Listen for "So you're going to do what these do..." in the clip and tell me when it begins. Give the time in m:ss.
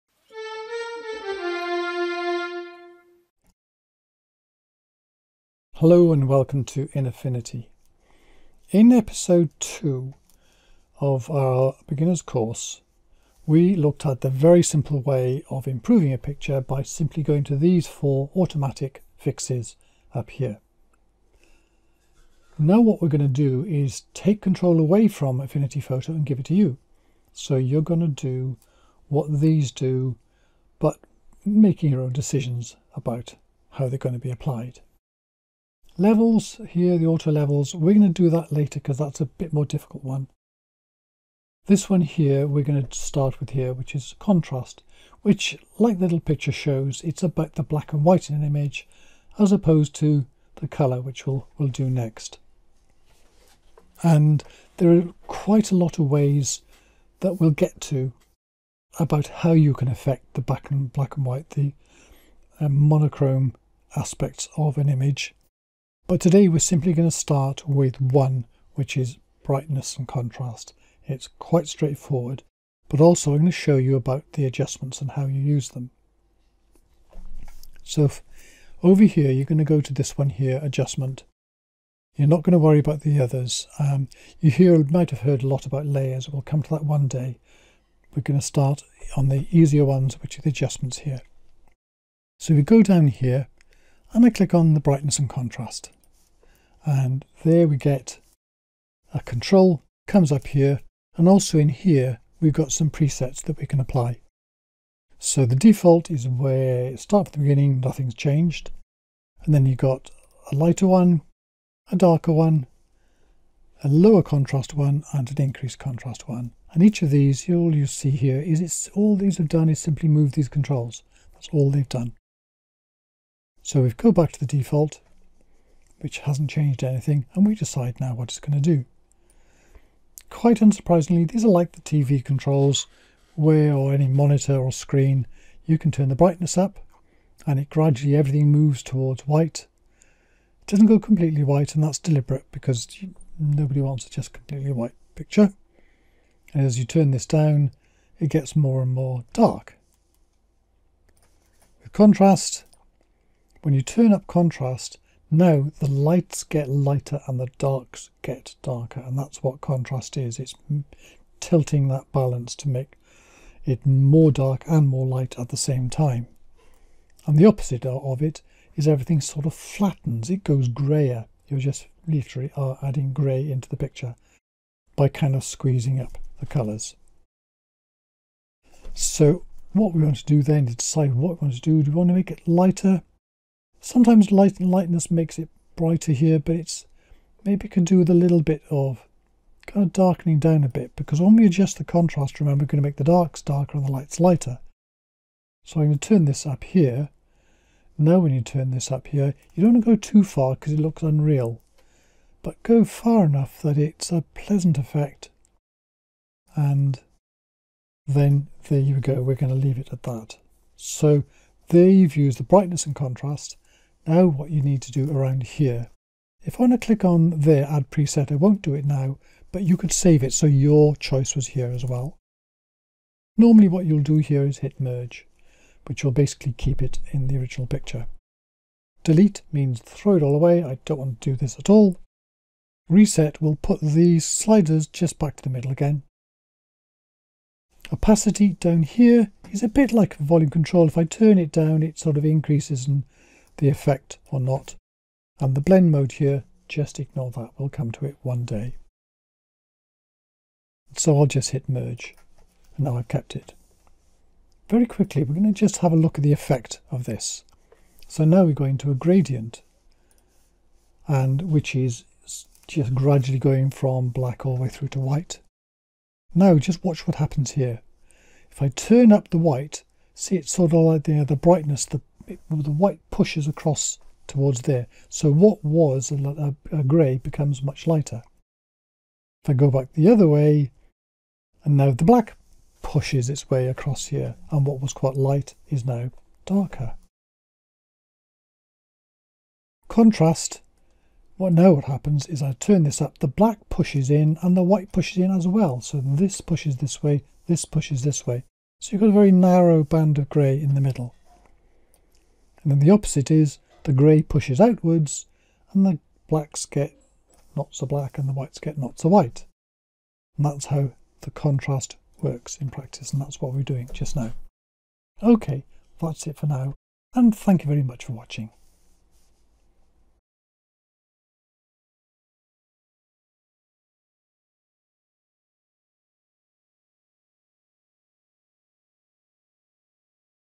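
0:27.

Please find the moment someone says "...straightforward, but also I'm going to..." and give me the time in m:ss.
1:11.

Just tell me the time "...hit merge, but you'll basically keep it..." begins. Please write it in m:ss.
3:44.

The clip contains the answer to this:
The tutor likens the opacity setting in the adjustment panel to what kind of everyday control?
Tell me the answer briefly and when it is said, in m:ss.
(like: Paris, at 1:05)
Volume control, at 4:00.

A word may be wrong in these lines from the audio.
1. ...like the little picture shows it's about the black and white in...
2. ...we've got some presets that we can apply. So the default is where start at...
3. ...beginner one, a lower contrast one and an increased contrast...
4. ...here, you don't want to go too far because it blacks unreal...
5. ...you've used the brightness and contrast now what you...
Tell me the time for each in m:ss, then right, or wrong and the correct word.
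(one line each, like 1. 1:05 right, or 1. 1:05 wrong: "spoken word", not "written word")
1. 0:45 right
2. 1:42 right
3. 1:51 wrong: "darker", not "beginner"
4. 3:19 wrong: "looks", not "blacks"
5. 3:31 right.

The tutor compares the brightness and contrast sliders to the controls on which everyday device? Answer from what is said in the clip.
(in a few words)
TV.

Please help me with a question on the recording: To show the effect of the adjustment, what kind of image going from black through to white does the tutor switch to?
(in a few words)
A gradient.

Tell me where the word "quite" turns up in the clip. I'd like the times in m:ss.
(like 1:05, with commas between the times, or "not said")
0:55, 1:11, 2:10, 4:44.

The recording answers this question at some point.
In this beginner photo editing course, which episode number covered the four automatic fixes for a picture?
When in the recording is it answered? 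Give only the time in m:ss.
0:08.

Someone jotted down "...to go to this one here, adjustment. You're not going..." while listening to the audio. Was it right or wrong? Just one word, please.
right.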